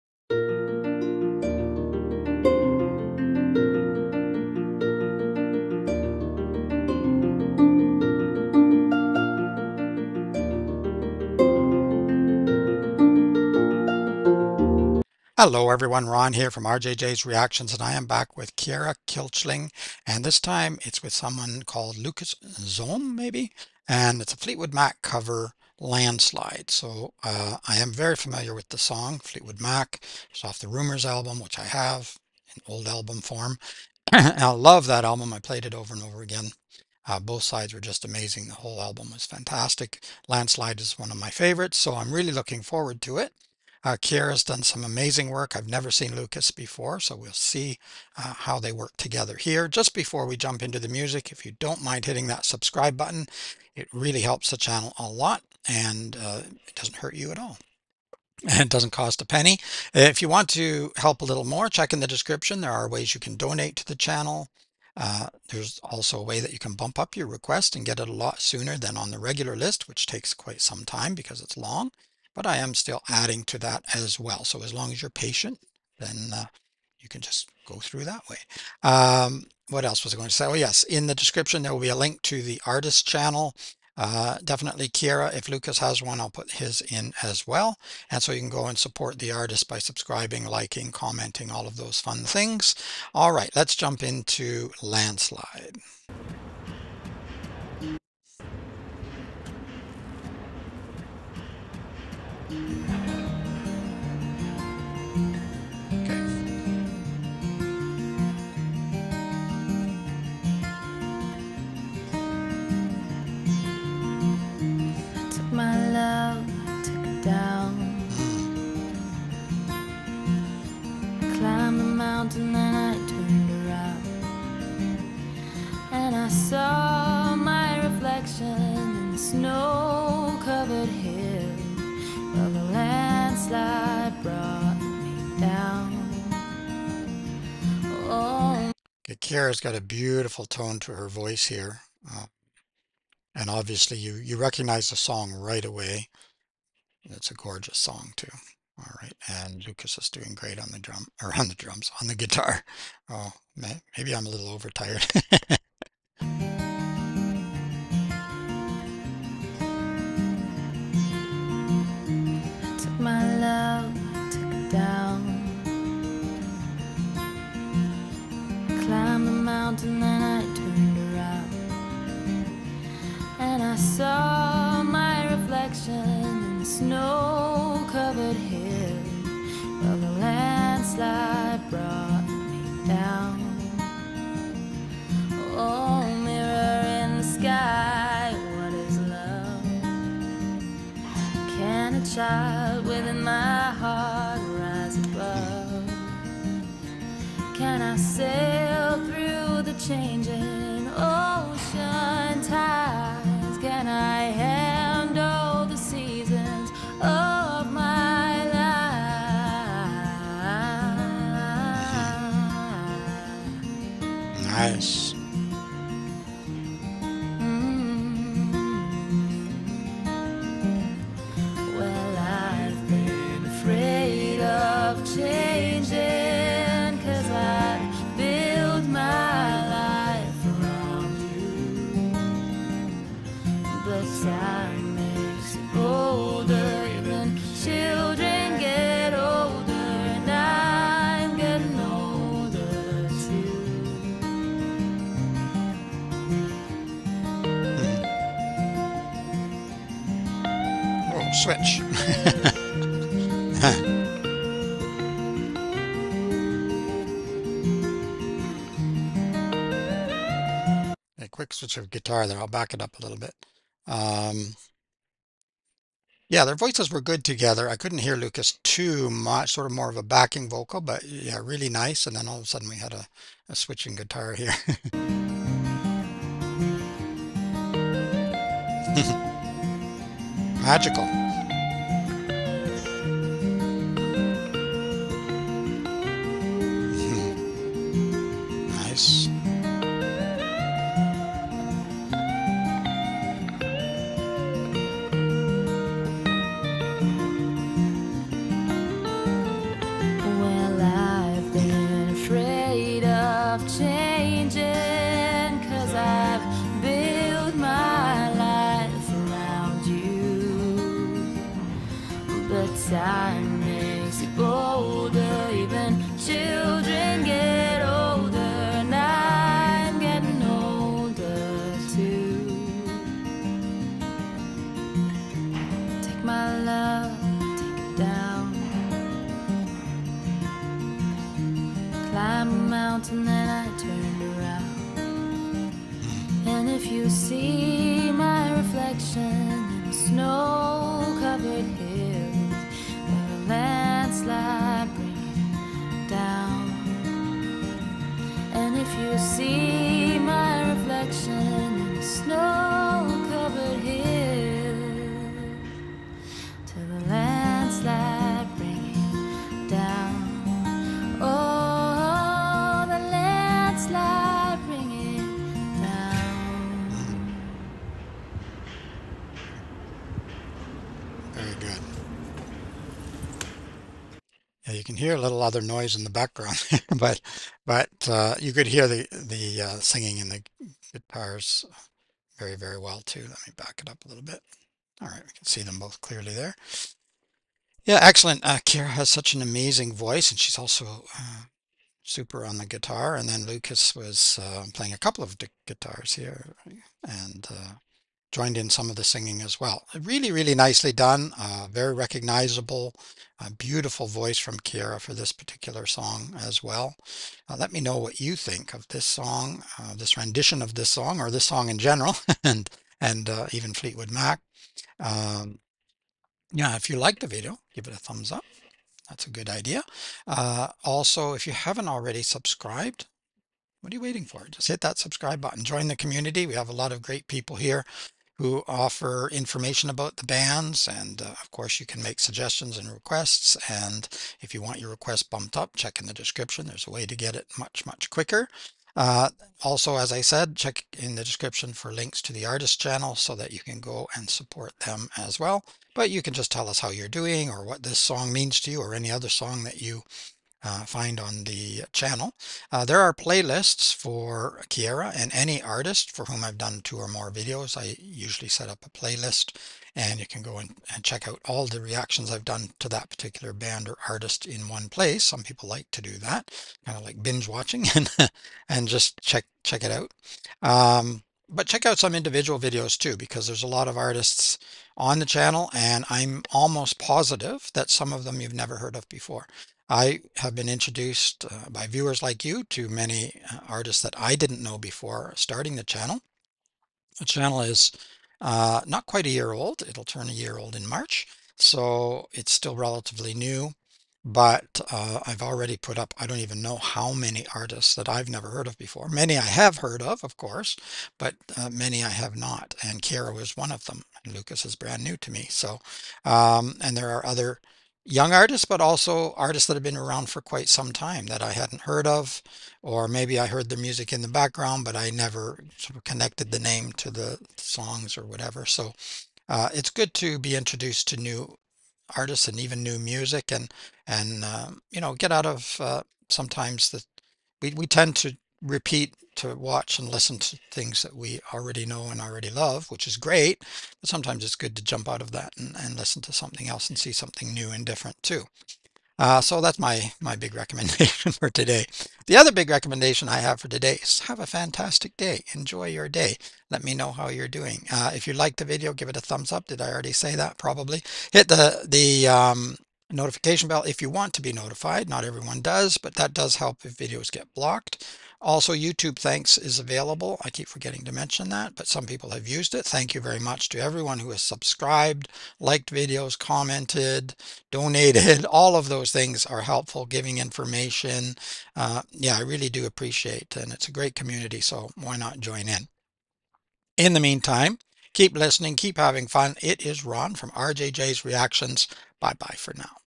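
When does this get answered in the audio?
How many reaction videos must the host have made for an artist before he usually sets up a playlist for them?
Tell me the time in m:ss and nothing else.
7:36.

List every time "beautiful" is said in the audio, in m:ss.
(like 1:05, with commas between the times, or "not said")
2:19, 6:43.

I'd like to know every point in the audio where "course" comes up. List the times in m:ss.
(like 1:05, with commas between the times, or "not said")
7:11, 8:20.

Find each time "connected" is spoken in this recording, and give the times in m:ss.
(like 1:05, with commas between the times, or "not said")
8:36.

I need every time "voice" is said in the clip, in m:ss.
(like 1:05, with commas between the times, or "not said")
2:21, 4:26, 6:29, 6:44.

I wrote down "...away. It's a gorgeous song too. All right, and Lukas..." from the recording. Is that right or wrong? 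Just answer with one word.
right.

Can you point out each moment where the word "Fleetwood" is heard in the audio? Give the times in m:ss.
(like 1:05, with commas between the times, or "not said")
0:24, 0:29, 6:53.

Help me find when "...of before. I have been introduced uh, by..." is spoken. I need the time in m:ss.
7:58.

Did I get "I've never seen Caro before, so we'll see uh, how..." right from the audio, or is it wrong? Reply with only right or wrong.
wrong.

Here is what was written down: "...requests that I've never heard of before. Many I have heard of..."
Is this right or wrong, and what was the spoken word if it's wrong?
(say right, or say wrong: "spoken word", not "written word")
wrong: "artists", not "requests".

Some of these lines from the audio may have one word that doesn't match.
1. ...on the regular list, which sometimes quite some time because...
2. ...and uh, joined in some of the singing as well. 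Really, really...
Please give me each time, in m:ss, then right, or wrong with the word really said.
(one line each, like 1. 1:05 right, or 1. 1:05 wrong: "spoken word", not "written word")
1. 1:08 wrong: "takes", not "sometimes"
2. 6:37 right.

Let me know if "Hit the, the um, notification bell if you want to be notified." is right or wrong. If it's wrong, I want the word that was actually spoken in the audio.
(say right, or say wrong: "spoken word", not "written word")
right.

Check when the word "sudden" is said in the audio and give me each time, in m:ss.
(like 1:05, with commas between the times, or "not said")
4:32.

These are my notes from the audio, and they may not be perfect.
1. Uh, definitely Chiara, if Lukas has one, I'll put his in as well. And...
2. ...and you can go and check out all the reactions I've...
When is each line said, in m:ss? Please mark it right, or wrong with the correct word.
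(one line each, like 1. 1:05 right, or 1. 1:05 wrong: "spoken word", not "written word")
1. 1:23 right
2. 7:39 right.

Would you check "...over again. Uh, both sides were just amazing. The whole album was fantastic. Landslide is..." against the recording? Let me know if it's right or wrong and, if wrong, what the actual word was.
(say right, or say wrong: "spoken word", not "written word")
right.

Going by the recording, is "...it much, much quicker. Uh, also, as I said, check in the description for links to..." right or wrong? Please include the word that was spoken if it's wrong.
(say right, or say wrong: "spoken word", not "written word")
right.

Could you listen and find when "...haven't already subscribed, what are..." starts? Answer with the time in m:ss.
7:01.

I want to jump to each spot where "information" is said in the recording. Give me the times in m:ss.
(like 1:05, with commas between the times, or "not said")
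7:09, 9:30.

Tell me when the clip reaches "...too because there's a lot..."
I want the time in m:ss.
7:52.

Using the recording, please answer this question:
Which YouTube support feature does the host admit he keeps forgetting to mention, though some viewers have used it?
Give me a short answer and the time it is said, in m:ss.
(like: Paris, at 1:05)
YouTube Thanks, at 9:18.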